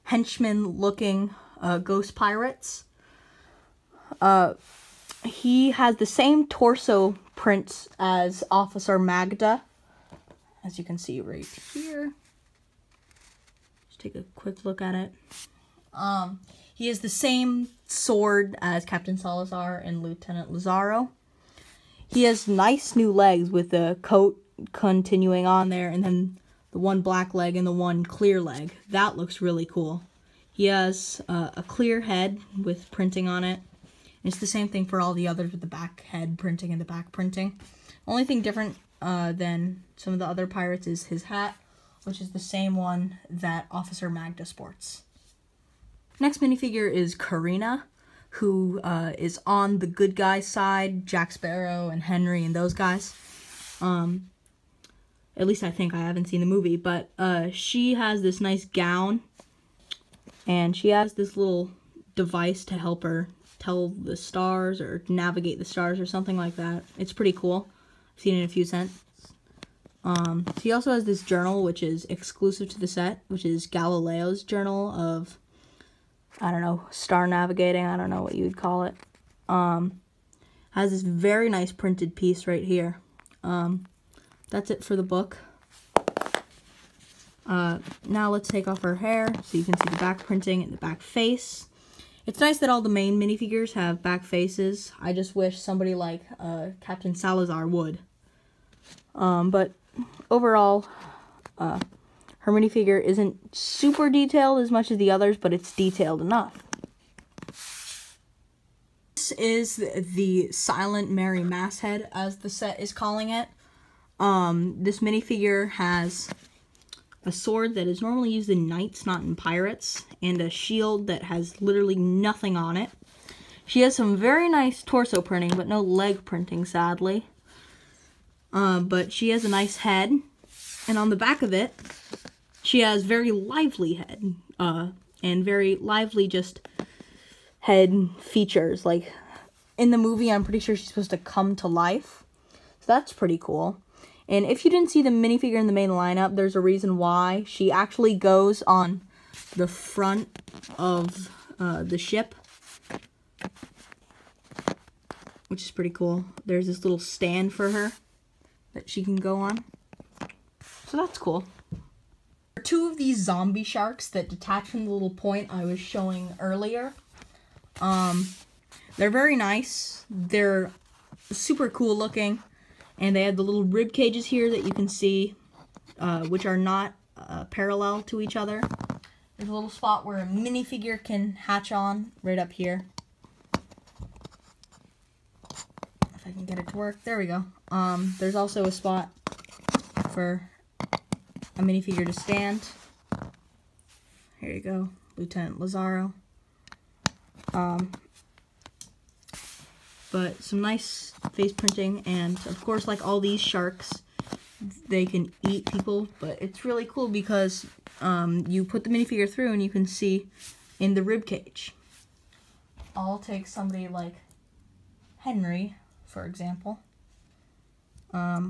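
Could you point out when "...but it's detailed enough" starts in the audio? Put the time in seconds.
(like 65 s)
105 s.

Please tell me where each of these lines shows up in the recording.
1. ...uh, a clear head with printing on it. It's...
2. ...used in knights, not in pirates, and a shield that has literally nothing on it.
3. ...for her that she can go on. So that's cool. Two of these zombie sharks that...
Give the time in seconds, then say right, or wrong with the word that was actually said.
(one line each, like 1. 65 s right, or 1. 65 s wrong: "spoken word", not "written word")
1. 31 s right
2. 118 s right
3. 157 s right.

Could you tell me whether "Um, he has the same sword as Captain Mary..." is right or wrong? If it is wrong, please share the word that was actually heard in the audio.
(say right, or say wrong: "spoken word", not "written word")
wrong: "Salazar", not "Mary".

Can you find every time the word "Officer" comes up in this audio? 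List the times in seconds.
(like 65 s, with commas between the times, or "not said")
8 s, 43 s.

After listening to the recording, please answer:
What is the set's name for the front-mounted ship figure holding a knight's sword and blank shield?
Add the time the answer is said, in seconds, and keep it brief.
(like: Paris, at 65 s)
Silent Mary Masthead, at 110 s.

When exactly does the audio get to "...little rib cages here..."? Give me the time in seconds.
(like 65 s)
173 s.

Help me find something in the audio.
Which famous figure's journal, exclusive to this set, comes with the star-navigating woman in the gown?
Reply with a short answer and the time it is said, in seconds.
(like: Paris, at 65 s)
Galileo, at 73 s.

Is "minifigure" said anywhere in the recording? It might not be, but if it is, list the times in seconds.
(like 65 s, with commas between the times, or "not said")
46 s, 93 s, 102 s, 115 s, 145 s, 180 s, 191 s, 208 s.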